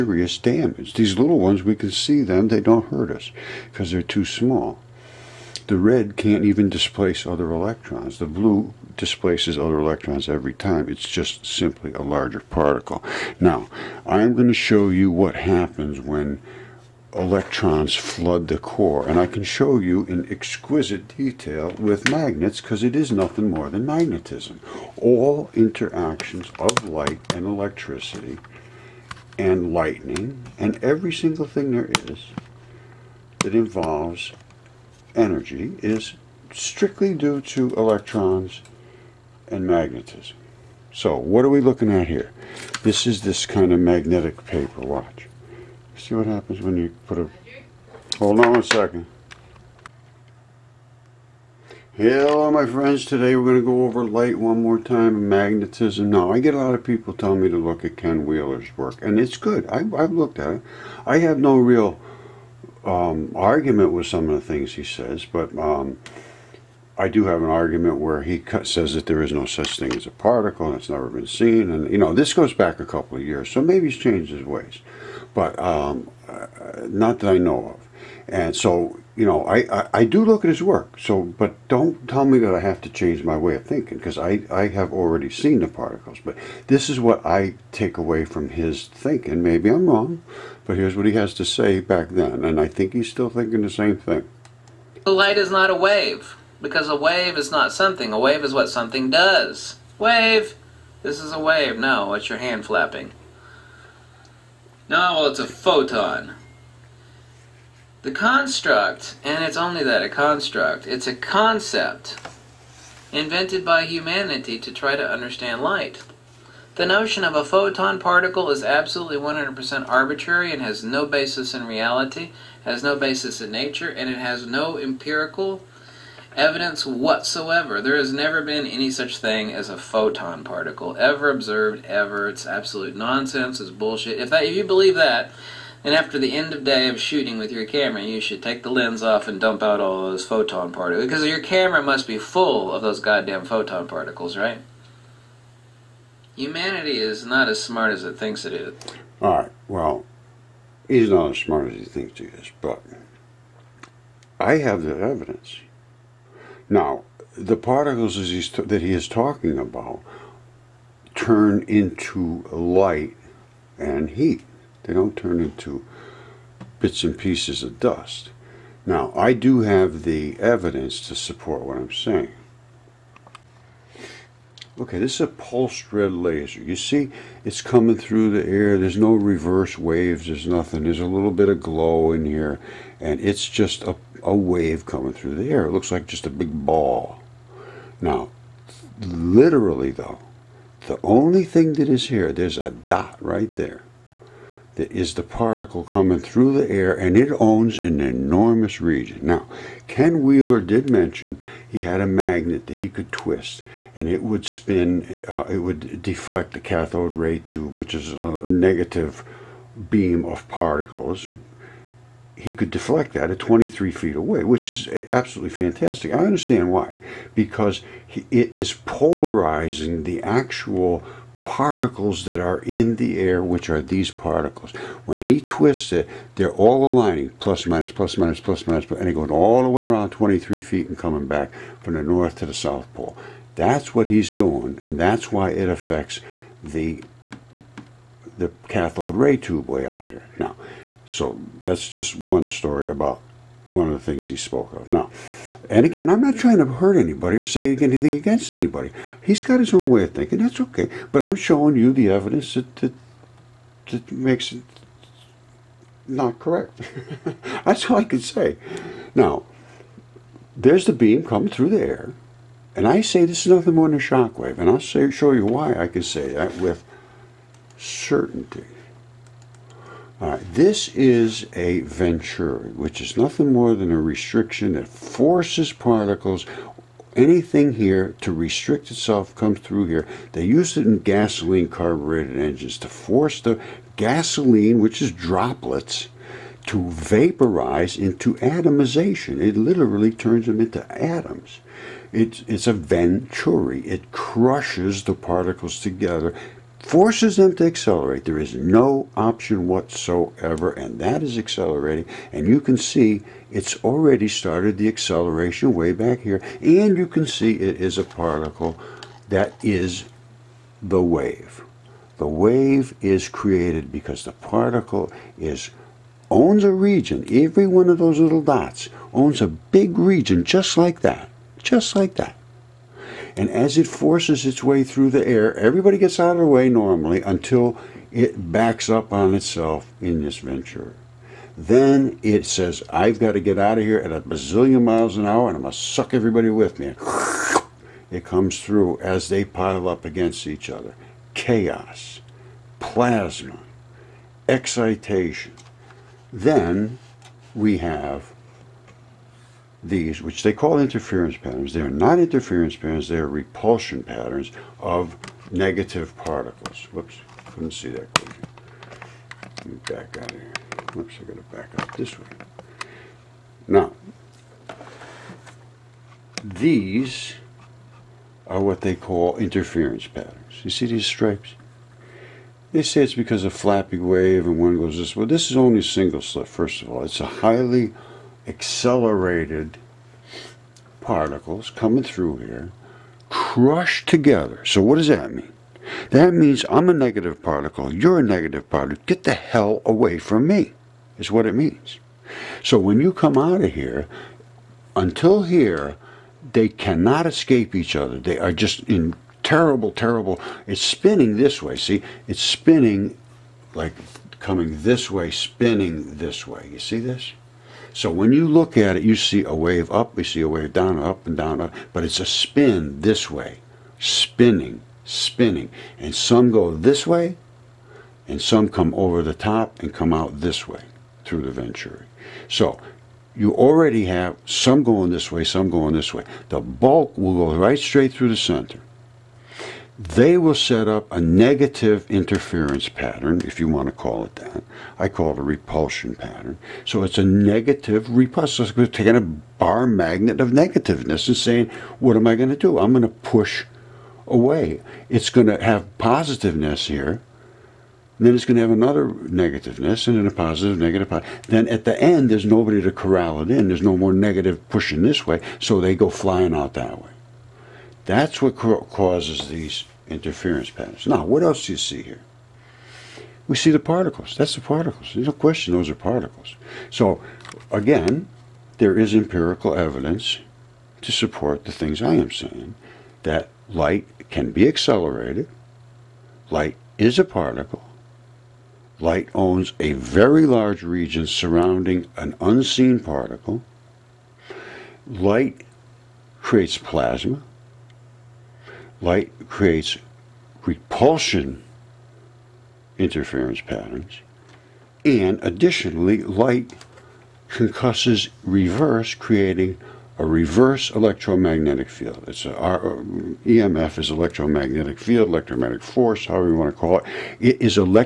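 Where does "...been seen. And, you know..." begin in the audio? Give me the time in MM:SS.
01:11.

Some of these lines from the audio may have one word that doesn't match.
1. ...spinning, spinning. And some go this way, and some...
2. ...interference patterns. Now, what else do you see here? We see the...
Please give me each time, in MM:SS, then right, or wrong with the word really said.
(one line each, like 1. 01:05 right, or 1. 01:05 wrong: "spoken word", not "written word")
1. 06:53 right
2. 07:40 right.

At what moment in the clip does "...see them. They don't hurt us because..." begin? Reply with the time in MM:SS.
00:01.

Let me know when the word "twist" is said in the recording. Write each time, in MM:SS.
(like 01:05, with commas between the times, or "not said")
03:23, 03:45.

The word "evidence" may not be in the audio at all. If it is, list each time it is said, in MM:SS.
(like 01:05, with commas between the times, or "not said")
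02:06, 02:34, 02:50, 04:12, 07:49.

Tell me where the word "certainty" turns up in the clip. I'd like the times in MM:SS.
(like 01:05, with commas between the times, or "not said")
04:27.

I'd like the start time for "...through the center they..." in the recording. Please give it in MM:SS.
07:08.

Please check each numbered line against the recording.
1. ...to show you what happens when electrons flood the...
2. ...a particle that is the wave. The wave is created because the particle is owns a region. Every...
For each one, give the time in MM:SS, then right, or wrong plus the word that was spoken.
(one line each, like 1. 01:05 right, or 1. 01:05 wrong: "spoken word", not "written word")
1. 00:14 right
2. 05:07 right.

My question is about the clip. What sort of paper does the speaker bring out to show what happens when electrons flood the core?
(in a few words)
magnetic paper.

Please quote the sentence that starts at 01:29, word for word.
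Maybe I'm wrong, but here's what he has to say back then.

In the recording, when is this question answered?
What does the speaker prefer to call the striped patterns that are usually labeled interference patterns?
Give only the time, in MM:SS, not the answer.
05:53.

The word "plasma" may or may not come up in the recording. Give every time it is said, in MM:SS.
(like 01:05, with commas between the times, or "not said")
05:42, 08:06.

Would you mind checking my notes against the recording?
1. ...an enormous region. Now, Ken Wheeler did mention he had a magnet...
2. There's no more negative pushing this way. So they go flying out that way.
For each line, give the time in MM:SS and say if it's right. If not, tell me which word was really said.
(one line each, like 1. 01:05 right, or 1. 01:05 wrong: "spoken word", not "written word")
1. 03:17 right
2. 07:33 right.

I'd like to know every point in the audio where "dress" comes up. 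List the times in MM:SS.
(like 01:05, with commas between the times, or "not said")
not said.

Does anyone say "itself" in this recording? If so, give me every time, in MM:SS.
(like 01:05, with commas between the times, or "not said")
04:38, 05:29.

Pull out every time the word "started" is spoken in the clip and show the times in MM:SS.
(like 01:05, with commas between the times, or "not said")
05:04.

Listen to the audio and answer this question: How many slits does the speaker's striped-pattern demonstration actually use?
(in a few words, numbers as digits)
single slit.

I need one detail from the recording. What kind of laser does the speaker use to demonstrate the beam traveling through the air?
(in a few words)
pulsed red laser.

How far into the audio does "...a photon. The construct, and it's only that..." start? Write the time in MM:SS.
01:45.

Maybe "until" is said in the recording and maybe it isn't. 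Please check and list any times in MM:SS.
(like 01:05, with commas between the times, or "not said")
05:27, 06:34.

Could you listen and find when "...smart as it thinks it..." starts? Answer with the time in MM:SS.
02:27.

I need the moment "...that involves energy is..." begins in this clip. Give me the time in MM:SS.
00:33.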